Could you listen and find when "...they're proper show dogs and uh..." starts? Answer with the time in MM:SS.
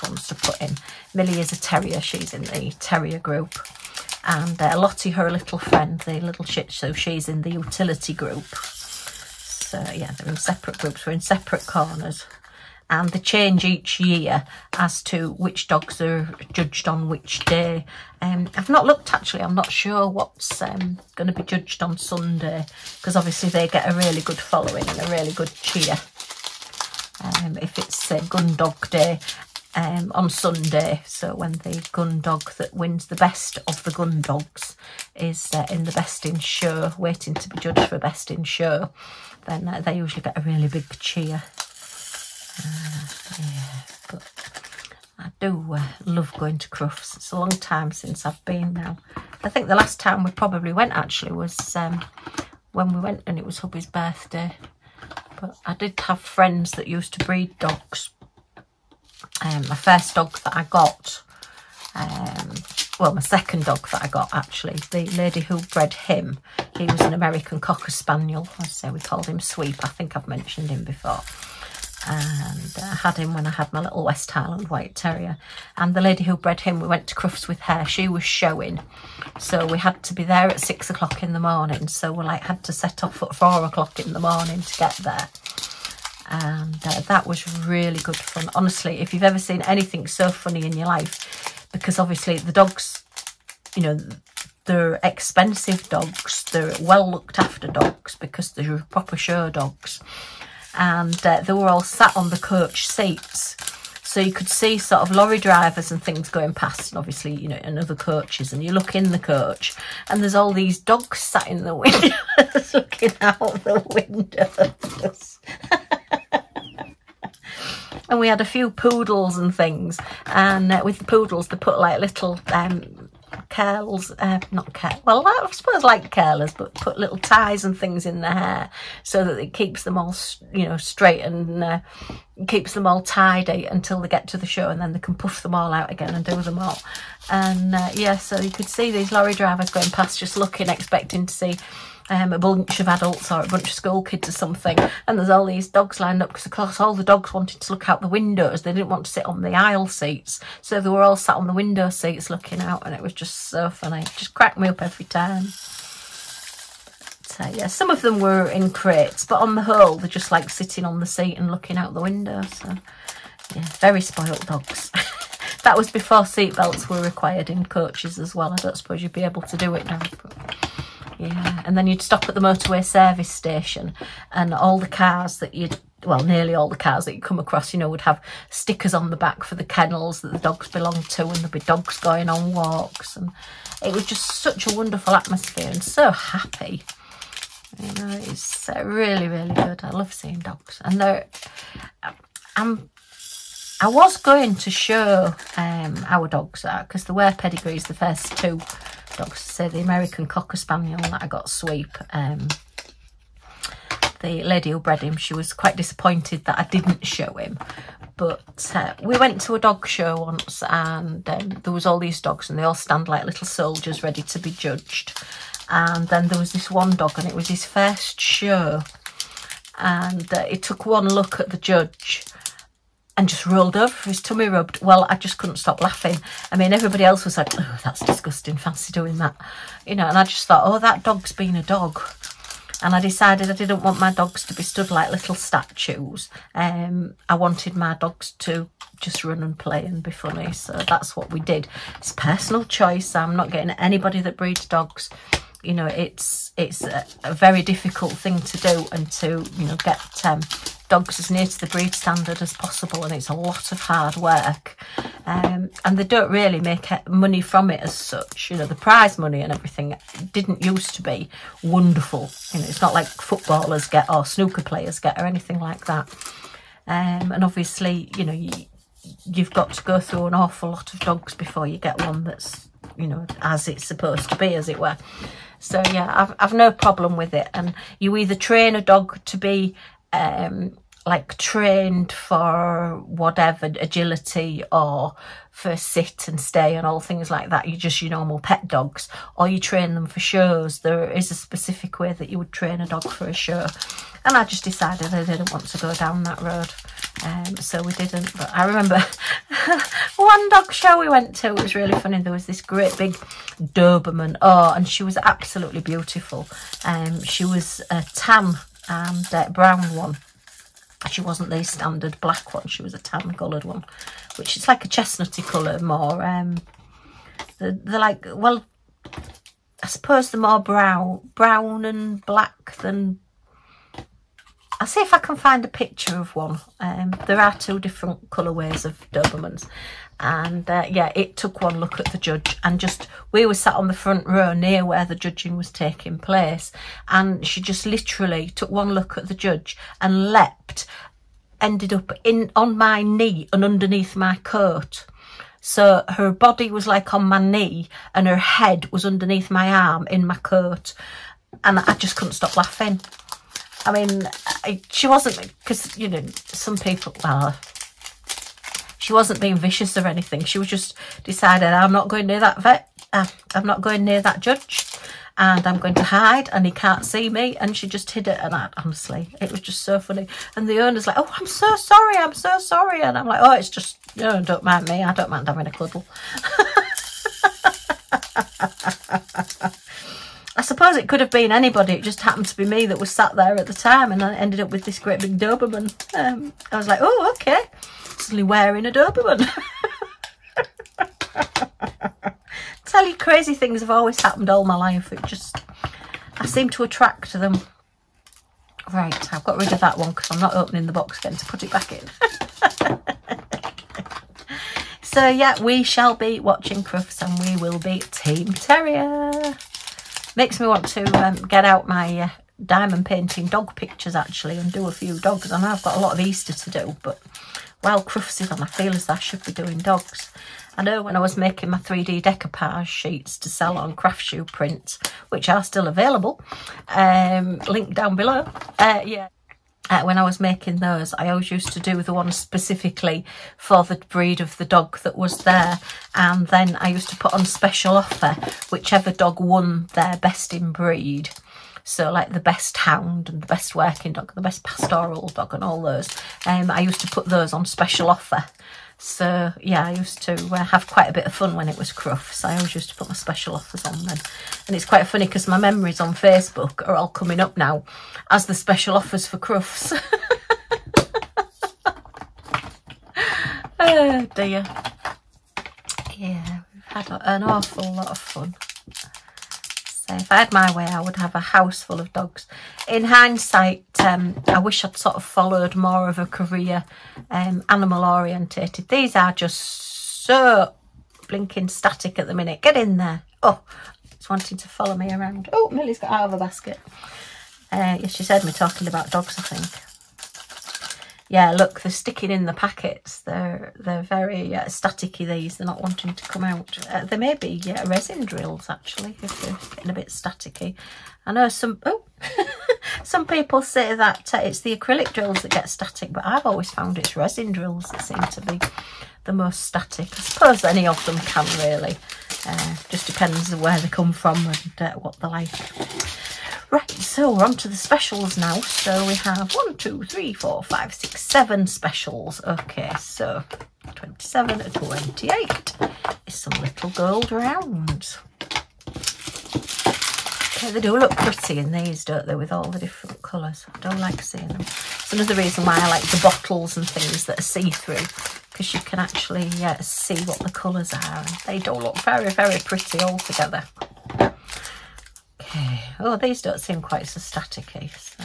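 01:38.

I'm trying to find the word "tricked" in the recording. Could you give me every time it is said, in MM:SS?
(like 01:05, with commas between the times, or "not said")
not said.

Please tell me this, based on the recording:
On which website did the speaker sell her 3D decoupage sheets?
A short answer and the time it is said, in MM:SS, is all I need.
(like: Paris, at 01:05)
Craftsuprint, at 07:03.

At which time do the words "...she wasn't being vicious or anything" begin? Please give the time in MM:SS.
05:58.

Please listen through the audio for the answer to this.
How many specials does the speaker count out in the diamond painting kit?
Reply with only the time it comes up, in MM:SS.
08:41.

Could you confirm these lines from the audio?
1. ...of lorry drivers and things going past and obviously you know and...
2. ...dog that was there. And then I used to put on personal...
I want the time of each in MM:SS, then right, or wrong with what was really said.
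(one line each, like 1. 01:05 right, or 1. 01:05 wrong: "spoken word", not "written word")
1. 01:45 right
2. 07:14 wrong: "special", not "personal".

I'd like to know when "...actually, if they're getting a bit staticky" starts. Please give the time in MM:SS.
08:18.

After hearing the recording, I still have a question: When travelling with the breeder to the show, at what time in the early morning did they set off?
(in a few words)
4 o'clock.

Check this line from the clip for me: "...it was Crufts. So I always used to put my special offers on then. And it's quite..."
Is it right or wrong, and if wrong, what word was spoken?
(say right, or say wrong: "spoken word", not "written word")
right.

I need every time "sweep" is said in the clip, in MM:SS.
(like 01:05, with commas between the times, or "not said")
01:09, 03:21.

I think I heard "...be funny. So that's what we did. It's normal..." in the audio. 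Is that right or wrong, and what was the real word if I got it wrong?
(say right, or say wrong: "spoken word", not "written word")
wrong: "personal", not "normal".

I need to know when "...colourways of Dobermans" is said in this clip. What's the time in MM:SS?
05:28.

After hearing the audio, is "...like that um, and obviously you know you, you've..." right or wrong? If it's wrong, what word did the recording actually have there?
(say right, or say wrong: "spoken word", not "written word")
right.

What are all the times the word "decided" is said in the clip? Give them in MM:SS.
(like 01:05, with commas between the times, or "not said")
03:53, 04:54, 06:01.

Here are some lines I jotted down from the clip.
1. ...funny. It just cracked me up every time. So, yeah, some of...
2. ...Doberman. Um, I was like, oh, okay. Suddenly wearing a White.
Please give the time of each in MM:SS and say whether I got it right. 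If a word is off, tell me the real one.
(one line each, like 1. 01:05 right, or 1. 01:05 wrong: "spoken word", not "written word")
1. 02:33 right
2. 06:25 wrong: "Doberman", not "White".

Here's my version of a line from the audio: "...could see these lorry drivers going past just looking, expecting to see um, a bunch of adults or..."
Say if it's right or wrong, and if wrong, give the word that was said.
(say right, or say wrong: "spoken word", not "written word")
right.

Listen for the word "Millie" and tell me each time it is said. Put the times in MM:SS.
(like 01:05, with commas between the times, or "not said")
00:01, 08:05.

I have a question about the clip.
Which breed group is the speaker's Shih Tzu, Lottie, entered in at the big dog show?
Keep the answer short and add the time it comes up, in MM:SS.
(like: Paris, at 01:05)
utility group, at 00:07.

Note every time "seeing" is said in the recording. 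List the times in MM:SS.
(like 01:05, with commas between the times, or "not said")
03:10, 08:54.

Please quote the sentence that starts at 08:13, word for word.
They're they're very uh, staticky, these.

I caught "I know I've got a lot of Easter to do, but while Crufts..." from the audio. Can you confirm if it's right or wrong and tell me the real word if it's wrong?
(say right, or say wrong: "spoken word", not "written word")
right.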